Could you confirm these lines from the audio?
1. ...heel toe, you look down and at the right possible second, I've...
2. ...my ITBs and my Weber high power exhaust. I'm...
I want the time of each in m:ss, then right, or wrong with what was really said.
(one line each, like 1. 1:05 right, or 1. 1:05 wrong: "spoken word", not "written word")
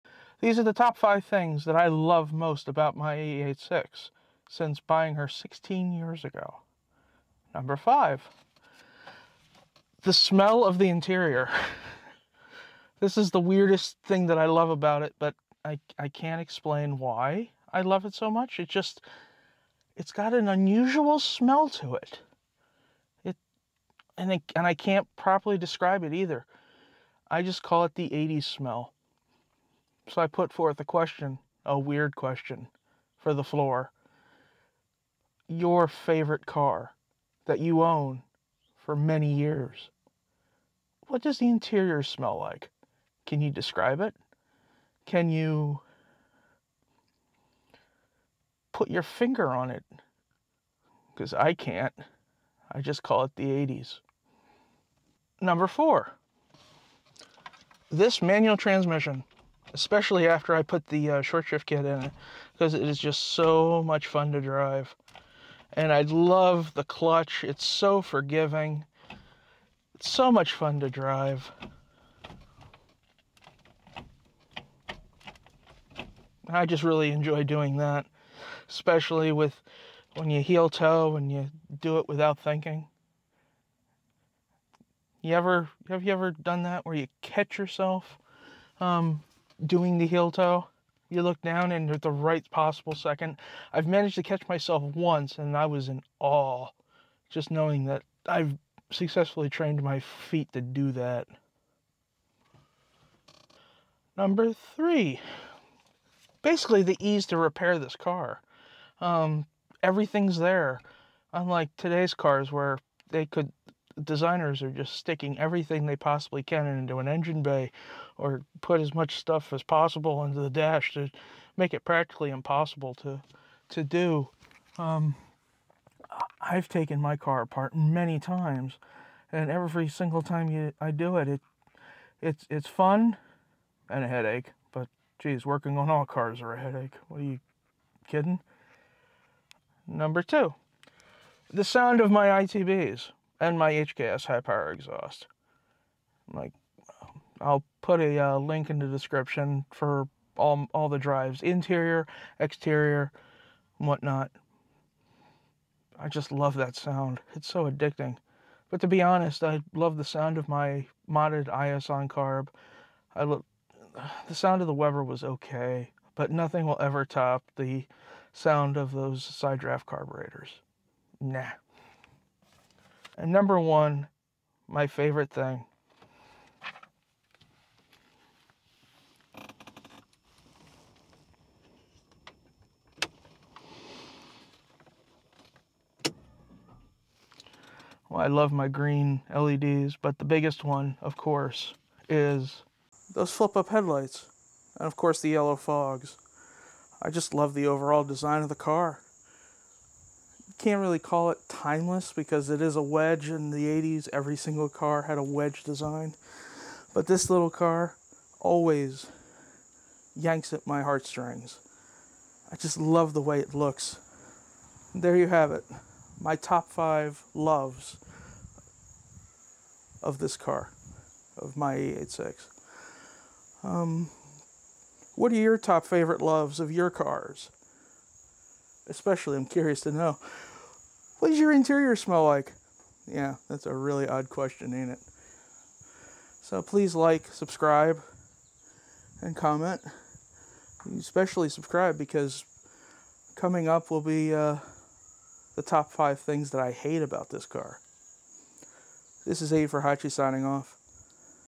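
1. 1:30 right
2. 2:22 wrong: "HKS", not "Weber".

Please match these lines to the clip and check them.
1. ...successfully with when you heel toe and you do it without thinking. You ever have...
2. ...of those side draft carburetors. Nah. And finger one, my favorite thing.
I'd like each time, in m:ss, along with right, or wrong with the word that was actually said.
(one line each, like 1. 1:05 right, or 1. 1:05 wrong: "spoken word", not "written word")
1. 1:18 wrong: "especially", not "successfully"
2. 2:48 wrong: "number", not "finger".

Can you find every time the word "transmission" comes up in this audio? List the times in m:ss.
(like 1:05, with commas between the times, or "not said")
0:58.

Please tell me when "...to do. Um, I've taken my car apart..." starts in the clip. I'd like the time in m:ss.
2:03.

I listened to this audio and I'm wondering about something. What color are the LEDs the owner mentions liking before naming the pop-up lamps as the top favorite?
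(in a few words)
green.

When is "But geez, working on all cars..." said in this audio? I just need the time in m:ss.
2:14.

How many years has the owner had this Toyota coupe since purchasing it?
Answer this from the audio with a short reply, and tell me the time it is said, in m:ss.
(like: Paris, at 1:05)
16, at 0:05.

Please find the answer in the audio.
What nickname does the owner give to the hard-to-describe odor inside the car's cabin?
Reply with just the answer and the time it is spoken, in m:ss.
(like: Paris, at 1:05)
the 80s smell, at 0:27.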